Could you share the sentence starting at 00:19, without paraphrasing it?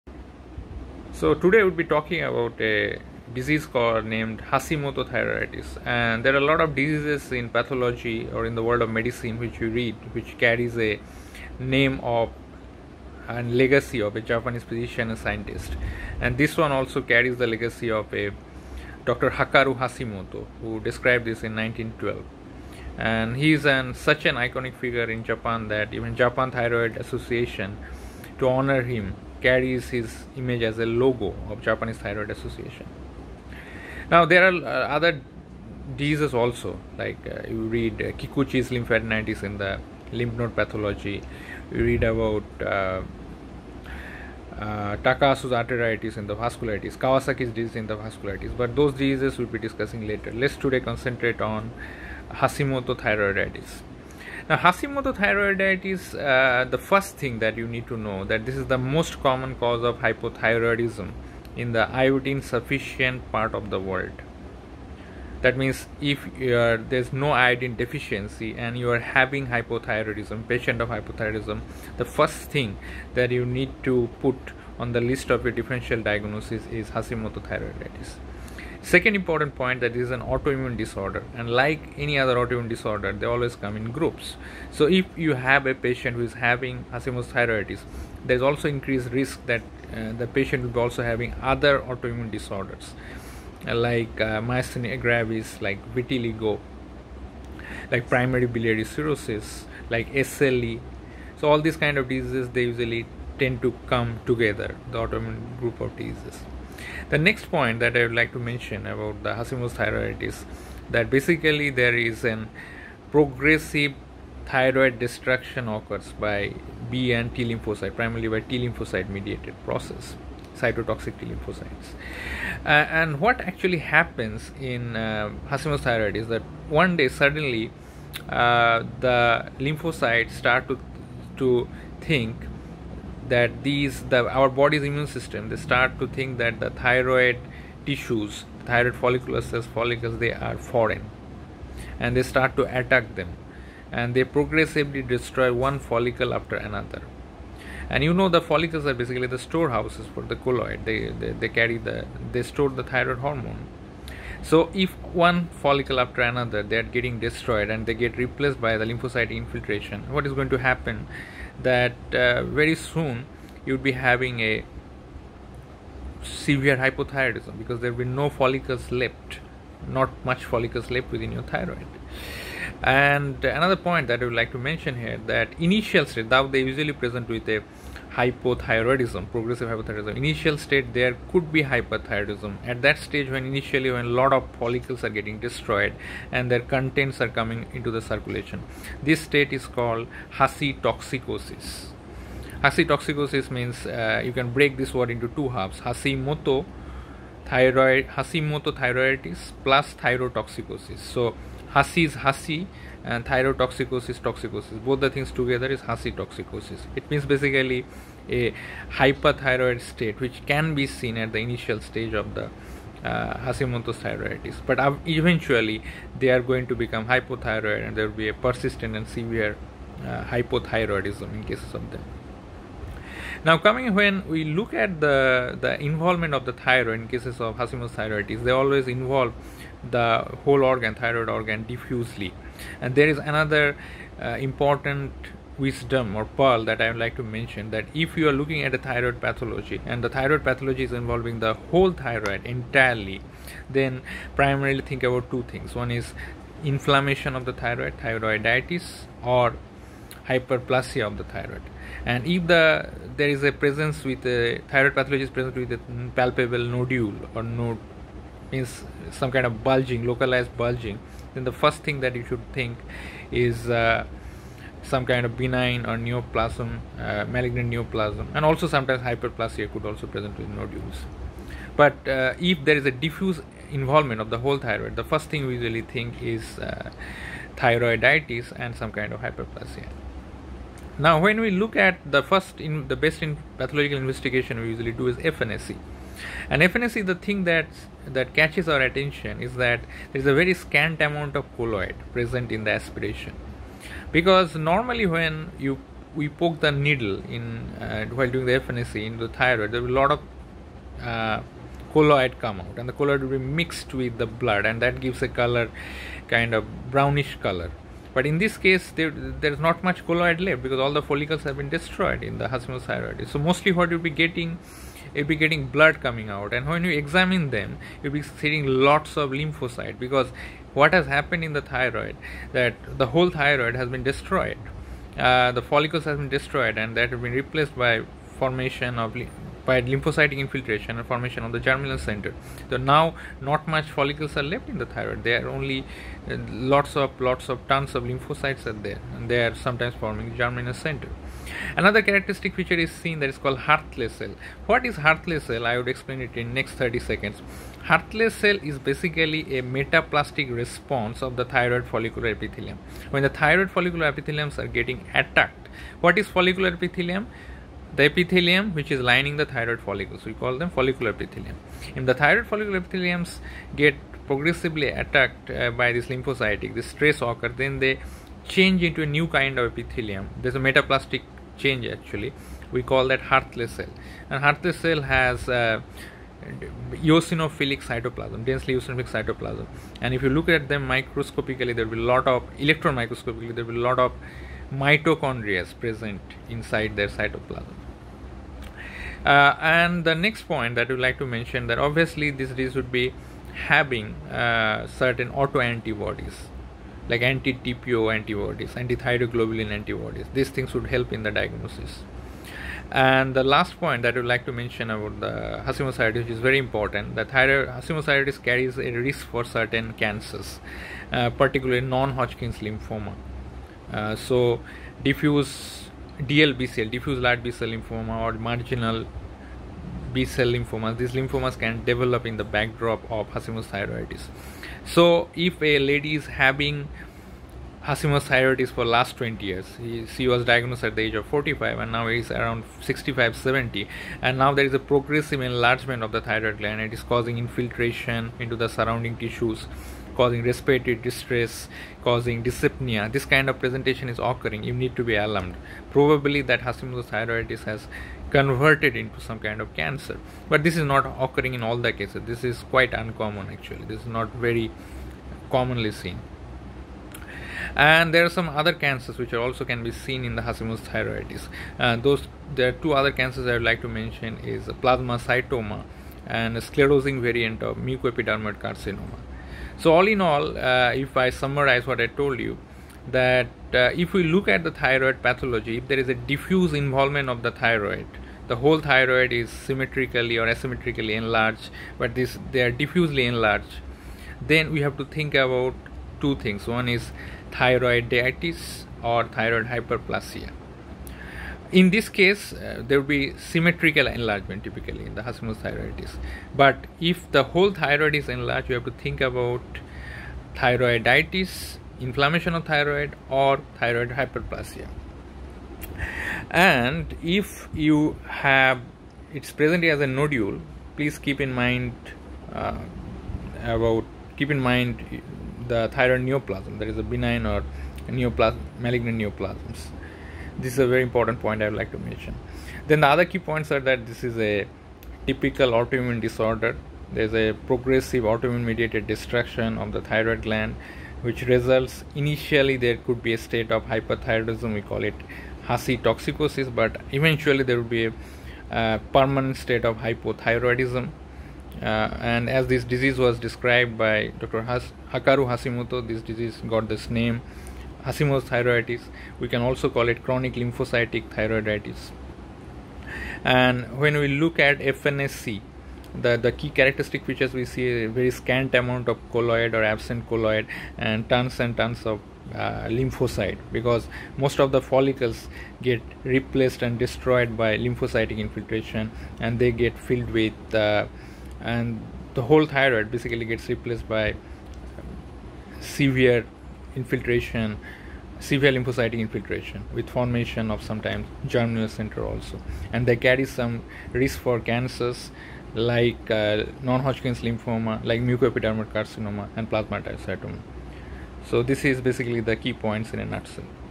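Hakaru Hashimoto, who described this in 1912.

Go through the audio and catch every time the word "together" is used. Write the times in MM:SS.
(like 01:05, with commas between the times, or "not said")
01:44, 03:25.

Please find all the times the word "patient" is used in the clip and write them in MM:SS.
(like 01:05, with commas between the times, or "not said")
01:10, 01:25, 01:30.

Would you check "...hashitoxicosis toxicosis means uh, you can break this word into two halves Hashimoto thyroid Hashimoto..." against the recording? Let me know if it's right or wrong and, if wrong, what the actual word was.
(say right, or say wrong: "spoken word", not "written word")
right.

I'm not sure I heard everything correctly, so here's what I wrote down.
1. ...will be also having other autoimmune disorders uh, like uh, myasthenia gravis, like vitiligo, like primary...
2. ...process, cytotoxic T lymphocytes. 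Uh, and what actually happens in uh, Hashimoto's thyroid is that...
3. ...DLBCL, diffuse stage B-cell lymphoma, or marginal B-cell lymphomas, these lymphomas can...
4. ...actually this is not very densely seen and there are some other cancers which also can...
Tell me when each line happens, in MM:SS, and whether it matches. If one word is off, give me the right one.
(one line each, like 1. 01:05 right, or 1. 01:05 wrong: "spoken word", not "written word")
1. 01:30 right
2. 01:59 right
3. 06:56 wrong: "large", not "stage"
4. 07:33 wrong: "commonly", not "densely".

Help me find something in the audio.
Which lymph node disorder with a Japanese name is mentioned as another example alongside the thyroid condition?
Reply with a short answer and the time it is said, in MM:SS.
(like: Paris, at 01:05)
Kikuchi's lymphadenitis, at 00:38.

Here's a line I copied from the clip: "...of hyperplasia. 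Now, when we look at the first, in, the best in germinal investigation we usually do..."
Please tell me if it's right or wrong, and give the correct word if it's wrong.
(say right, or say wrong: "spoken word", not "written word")
wrong: "pathological", not "germinal".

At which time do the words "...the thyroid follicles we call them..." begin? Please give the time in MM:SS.
05:59.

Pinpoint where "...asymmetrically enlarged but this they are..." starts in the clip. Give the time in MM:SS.
08:00.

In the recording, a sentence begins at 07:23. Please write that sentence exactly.
This kind of presentation is occurring.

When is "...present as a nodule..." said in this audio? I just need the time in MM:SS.
08:29.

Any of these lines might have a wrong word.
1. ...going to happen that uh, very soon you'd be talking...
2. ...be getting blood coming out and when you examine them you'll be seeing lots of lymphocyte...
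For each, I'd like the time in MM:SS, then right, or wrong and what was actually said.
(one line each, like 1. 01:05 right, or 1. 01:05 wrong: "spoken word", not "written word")
1. 02:40 wrong: "having", not "talking"
2. 05:15 right.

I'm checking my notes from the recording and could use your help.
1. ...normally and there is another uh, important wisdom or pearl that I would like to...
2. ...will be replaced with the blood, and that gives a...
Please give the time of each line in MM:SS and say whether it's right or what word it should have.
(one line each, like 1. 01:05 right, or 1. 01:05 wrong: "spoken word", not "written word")
1. 03:51 wrong: "diffusely", not "normally"
2. 05:03 wrong: "mixed", not "replaced".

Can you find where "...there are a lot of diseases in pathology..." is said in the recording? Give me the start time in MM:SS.
00:06.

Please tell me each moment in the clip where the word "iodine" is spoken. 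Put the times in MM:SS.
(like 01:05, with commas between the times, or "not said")
01:01, 01:07.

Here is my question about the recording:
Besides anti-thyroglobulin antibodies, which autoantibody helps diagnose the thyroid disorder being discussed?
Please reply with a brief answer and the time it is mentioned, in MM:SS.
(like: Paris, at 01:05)
Anti-TPO antibodies, at 06:37.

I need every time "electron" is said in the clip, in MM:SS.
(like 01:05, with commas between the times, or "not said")
06:22.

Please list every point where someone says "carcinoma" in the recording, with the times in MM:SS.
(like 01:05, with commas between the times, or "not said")
07:48, 09:48.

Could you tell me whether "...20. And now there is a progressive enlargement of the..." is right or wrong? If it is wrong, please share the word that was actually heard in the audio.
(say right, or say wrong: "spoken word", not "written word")
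wrong: "70", not "20".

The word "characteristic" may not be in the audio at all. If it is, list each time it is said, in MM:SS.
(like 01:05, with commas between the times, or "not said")
05:42, 09:16.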